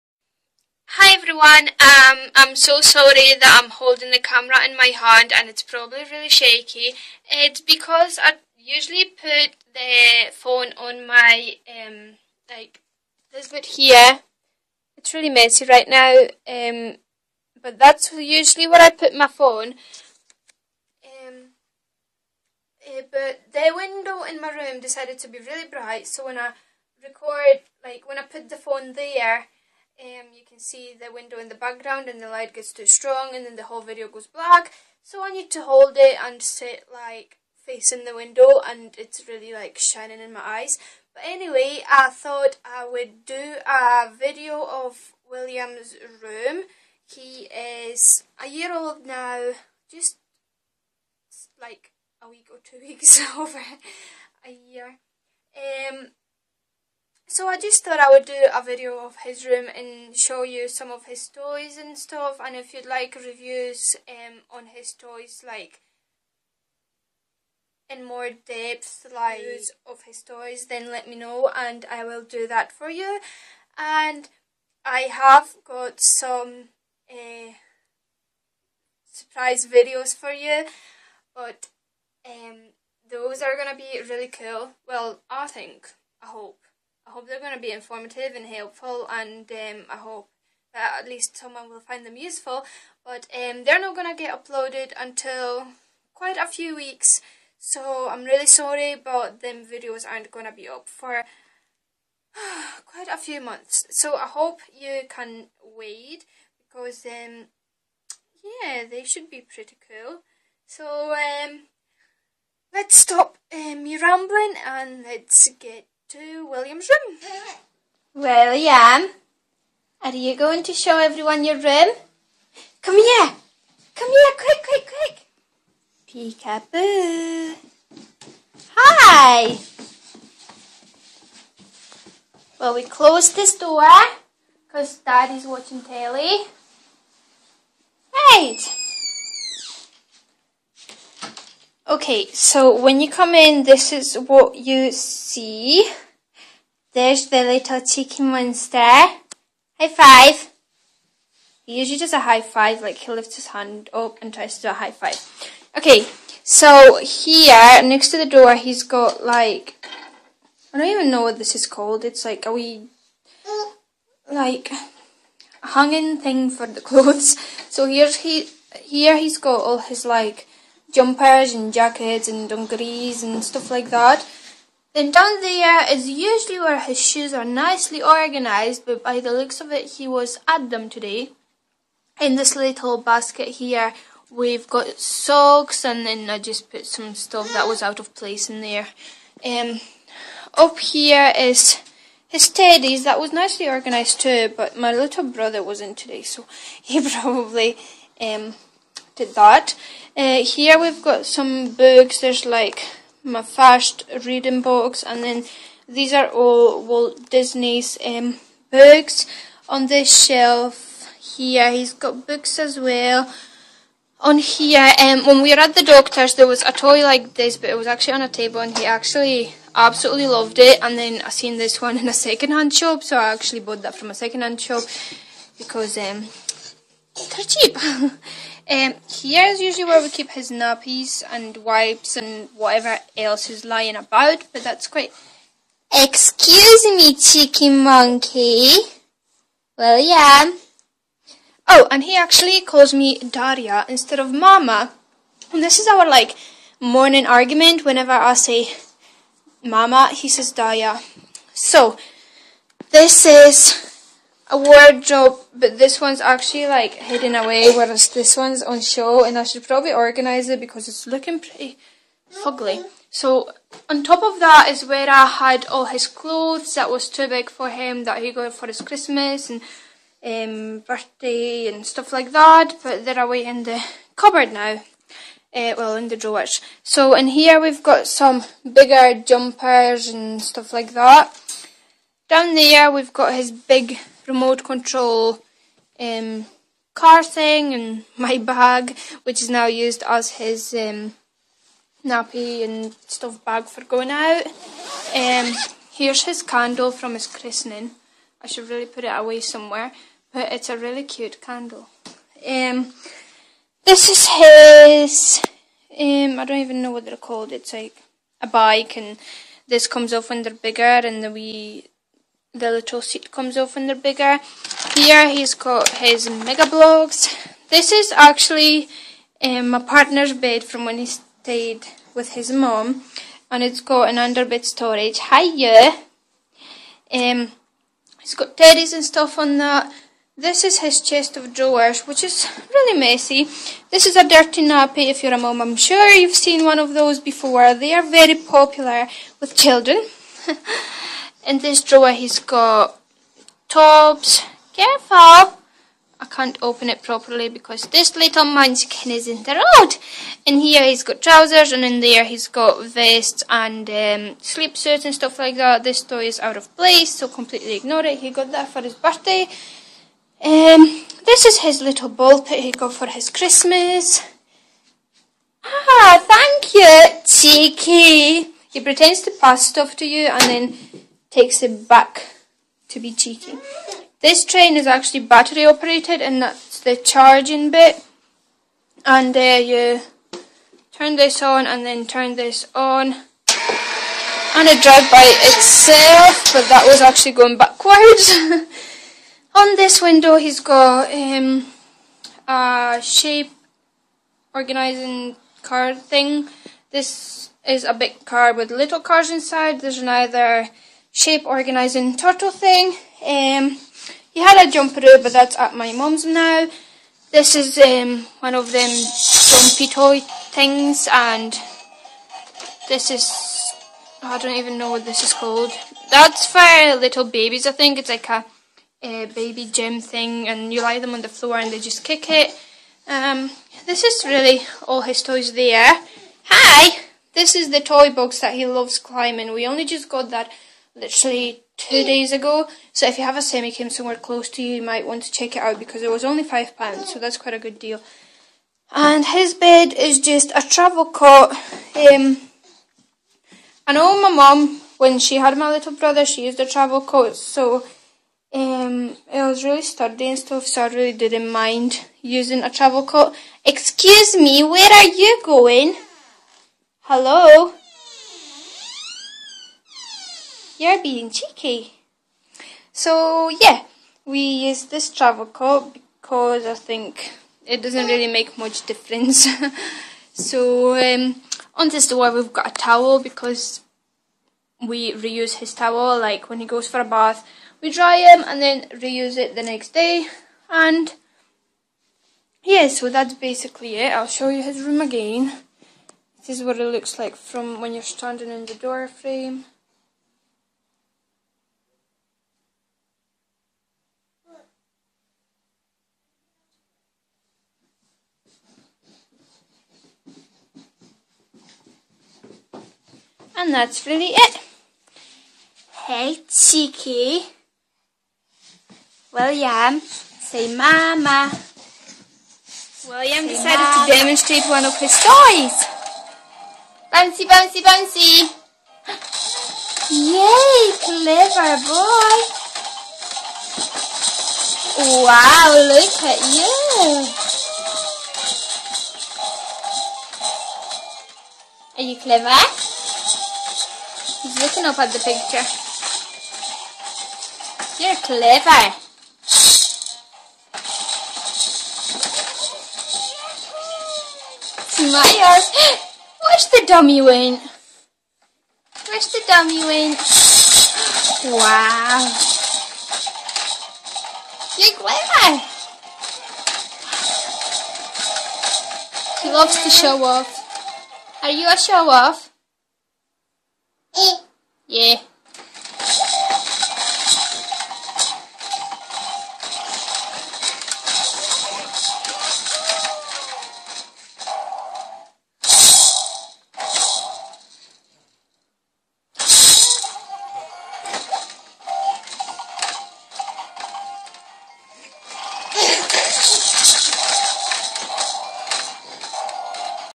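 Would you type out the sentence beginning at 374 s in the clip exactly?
This train is actually battery operated and that's the charging bit.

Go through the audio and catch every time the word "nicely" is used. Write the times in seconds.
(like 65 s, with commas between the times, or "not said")
177 s, 193 s.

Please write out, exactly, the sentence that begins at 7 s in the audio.
It's because I usually put the phone on my, um, like, this bit here.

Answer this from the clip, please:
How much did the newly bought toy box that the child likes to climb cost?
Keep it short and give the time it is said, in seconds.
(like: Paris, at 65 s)
5 pounds, at 436 s.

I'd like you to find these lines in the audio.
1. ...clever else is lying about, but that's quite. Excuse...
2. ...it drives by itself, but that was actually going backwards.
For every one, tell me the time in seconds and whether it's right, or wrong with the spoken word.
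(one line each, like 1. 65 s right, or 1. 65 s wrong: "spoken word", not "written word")
1. 232 s wrong: "whatever", not "clever"
2. 384 s right.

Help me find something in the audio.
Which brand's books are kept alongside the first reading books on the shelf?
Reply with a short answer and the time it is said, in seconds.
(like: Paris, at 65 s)
Walt Disney, at 206 s.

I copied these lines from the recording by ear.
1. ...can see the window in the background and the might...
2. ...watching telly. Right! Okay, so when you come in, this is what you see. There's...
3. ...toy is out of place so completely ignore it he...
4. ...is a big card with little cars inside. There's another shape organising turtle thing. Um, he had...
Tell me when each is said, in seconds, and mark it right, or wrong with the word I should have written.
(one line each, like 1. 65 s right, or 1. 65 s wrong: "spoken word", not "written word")
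1. 30 s wrong: "light", not "might"
2. 135 s right
3. 356 s right
4. 397 s right.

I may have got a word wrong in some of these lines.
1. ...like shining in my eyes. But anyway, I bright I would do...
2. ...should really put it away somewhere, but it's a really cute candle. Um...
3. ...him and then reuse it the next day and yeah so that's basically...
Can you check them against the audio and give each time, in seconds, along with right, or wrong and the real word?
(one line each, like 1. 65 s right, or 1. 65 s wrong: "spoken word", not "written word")
1. 39 s wrong: "thought", not "bright"
2. 298 s right
3. 478 s right.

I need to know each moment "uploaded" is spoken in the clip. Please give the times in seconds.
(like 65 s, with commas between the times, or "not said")
94 s.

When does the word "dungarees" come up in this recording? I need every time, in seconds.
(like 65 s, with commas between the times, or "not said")
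172 s.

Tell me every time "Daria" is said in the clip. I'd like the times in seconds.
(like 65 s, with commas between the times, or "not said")
243 s, 250 s.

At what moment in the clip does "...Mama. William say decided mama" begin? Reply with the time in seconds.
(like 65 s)
510 s.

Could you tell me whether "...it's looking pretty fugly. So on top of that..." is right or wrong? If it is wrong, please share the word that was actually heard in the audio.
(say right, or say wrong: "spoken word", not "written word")
right.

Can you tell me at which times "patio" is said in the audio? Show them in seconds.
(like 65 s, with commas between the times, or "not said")
not said.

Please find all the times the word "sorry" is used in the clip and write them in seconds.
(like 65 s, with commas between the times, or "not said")
2 s, 98 s.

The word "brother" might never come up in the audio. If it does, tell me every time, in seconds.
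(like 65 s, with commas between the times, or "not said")
195 s, 445 s.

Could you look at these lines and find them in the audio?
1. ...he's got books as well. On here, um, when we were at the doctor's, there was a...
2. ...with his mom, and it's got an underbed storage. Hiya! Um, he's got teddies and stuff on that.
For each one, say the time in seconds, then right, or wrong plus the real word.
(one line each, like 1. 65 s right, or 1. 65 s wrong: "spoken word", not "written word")
1. 211 s right
2. 322 s right.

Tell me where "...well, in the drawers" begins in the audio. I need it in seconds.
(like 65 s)
275 s.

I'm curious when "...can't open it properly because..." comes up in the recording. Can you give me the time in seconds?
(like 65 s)
346 s.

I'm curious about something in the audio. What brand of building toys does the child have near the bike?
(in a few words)
Mega Bloks.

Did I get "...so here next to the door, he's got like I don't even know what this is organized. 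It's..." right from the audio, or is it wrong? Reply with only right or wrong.
wrong.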